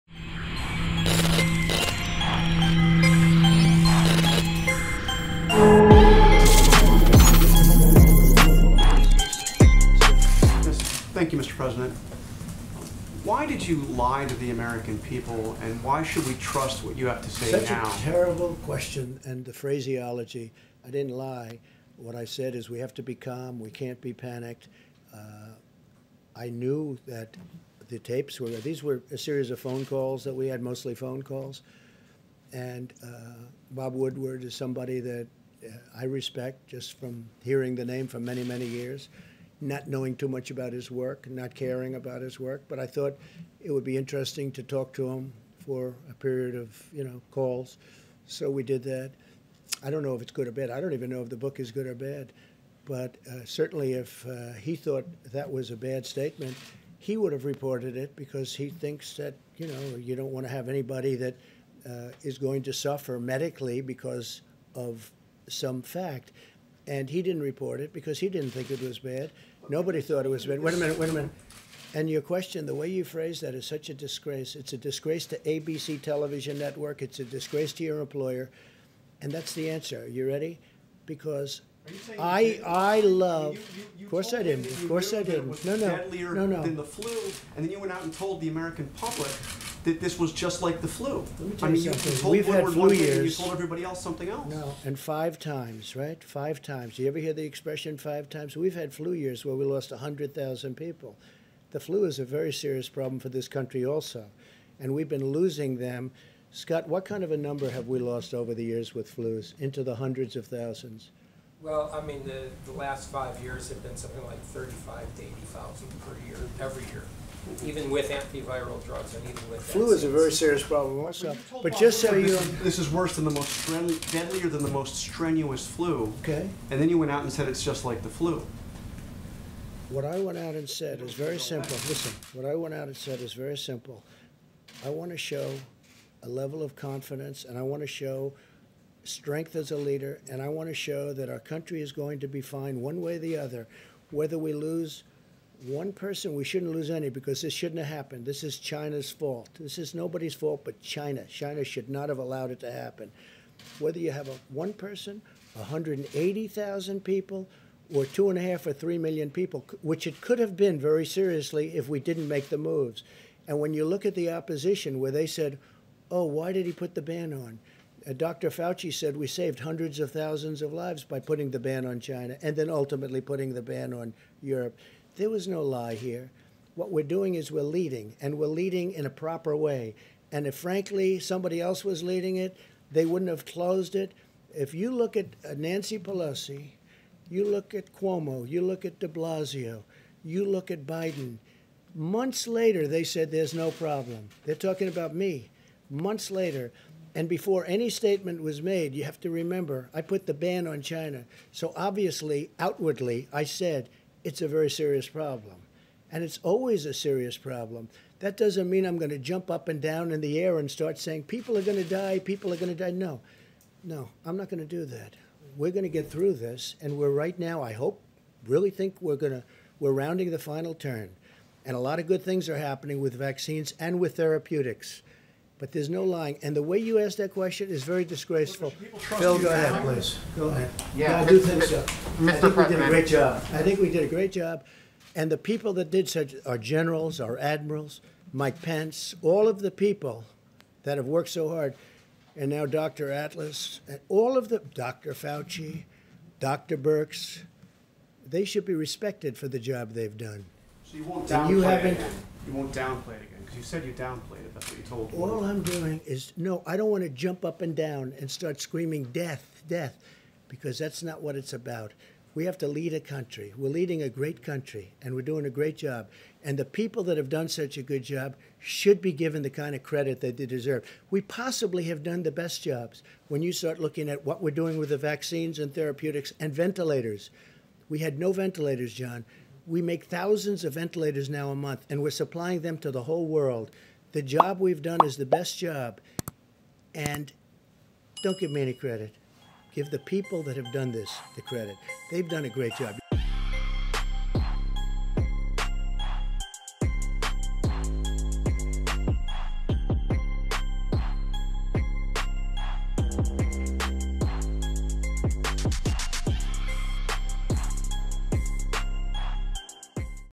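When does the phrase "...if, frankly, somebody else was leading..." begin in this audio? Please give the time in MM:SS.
03:00.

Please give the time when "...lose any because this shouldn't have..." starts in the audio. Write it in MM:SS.
02:26.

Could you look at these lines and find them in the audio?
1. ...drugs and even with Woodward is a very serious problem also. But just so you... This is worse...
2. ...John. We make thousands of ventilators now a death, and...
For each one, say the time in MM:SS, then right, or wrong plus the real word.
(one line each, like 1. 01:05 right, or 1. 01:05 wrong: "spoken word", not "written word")
1. 01:58 wrong: "Flu", not "Woodward"
2. 04:38 wrong: "month", not "death".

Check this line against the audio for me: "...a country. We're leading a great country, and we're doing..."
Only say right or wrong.
right.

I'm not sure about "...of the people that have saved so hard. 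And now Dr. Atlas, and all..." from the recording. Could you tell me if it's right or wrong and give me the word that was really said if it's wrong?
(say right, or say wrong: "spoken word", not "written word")
wrong: "worked", not "saved".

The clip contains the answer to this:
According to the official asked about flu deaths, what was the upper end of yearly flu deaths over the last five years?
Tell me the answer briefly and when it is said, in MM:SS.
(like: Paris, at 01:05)
80,000, at 01:55.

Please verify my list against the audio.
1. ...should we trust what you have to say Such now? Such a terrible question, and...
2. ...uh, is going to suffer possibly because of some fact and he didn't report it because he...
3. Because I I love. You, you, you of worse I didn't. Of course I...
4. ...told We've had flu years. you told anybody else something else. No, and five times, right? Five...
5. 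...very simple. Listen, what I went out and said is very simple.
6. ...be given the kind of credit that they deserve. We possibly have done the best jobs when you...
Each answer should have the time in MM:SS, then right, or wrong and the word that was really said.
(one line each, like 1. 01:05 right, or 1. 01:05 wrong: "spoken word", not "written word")
1. 00:16 right
2. 01:01 wrong: "medically", not "possibly"
3. 01:21 wrong: "course", not "worse"
4. 01:32 wrong: "everybody", not "anybody"
5. 02:11 right
6. 04:29 right.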